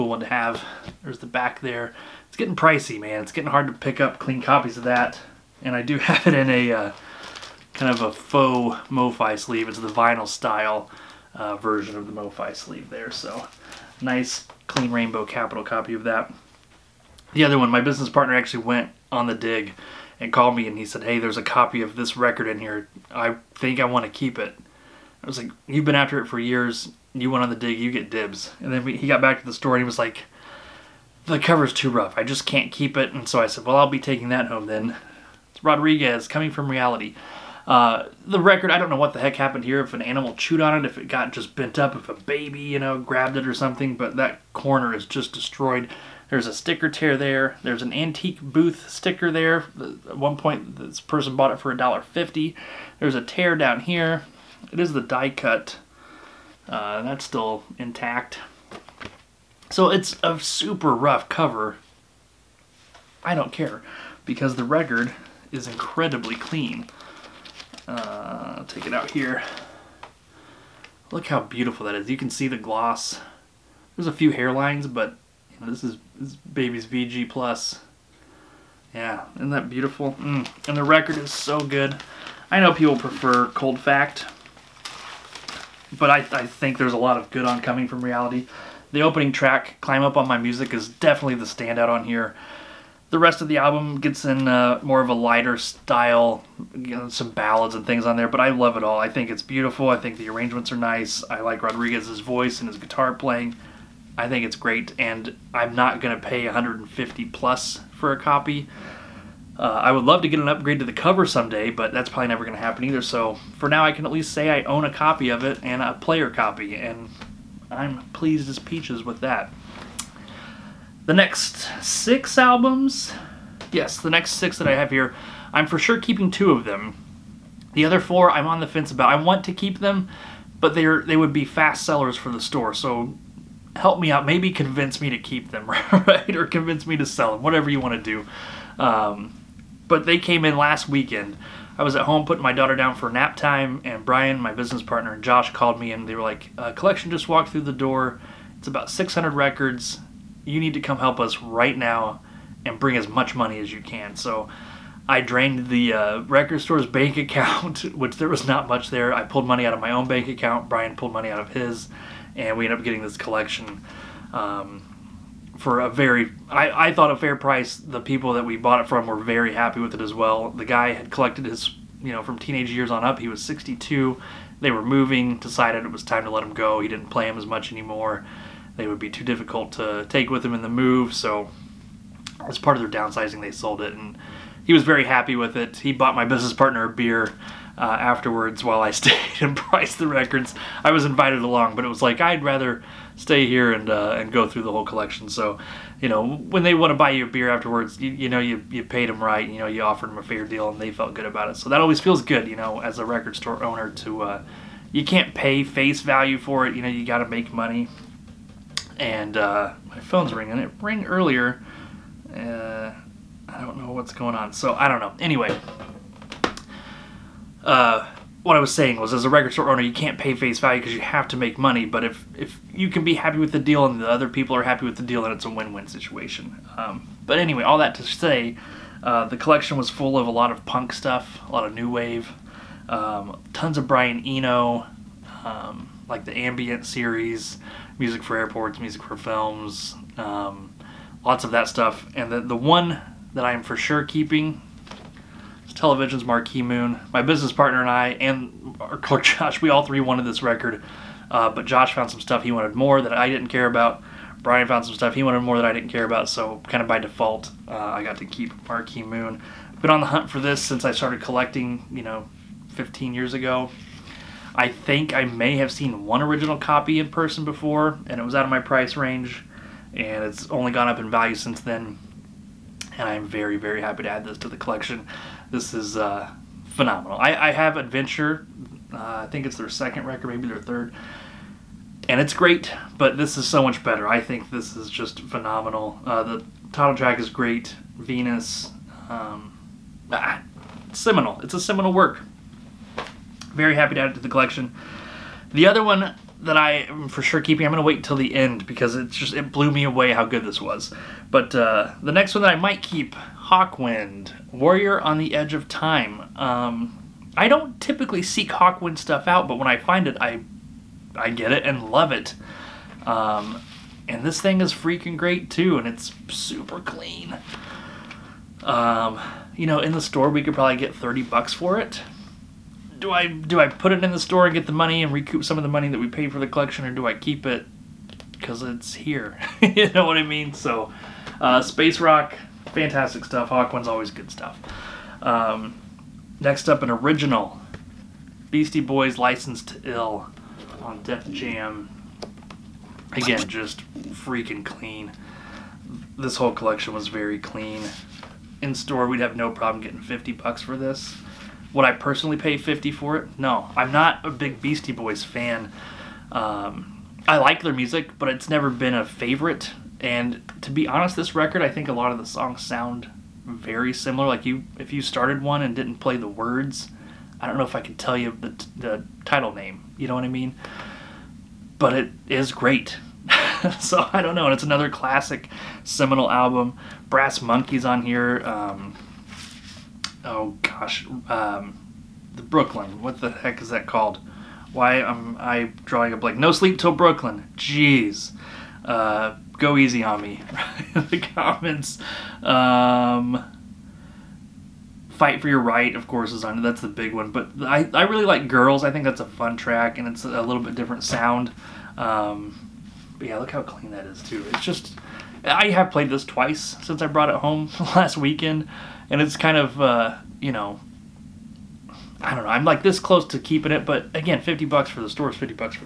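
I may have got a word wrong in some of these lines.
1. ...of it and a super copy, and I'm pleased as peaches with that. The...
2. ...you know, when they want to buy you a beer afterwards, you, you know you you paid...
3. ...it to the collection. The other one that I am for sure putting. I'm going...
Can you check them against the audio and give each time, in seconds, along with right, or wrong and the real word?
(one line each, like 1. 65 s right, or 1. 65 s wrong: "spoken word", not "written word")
1. 115 s wrong: "player", not "super"
2. 196 s right
3. 294 s wrong: "keeping", not "putting".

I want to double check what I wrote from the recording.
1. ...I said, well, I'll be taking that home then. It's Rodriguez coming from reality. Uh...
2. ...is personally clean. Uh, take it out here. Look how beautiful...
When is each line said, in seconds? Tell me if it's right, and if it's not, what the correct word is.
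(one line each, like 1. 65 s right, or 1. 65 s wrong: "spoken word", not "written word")
1. 33 s right
2. 65 s wrong: "incredibly", not "personally".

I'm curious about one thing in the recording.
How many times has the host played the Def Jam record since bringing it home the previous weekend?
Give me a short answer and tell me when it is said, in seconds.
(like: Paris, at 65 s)
twice, at 406 s.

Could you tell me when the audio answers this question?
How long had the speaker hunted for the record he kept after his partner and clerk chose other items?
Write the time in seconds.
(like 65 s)
262 s.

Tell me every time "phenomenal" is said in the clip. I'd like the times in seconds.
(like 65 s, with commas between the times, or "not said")
276 s, 285 s.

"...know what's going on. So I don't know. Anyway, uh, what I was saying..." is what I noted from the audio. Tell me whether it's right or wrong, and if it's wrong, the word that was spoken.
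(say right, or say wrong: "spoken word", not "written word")
right.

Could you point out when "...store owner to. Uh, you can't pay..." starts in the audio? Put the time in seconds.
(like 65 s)
203 s.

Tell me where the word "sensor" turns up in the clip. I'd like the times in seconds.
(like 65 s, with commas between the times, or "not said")
not said.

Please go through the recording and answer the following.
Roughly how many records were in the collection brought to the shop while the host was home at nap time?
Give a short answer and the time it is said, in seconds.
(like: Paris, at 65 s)
600, at 148 s.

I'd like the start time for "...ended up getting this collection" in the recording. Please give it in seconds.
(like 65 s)
162 s.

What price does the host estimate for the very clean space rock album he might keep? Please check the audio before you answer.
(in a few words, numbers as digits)
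30 bucks.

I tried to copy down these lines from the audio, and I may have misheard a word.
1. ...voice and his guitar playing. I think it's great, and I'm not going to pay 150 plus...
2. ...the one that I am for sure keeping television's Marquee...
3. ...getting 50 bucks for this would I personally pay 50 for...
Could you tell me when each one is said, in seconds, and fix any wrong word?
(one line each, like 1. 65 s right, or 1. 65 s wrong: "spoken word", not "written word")
1. 102 s right
2. 242 s right
3. 349 s right.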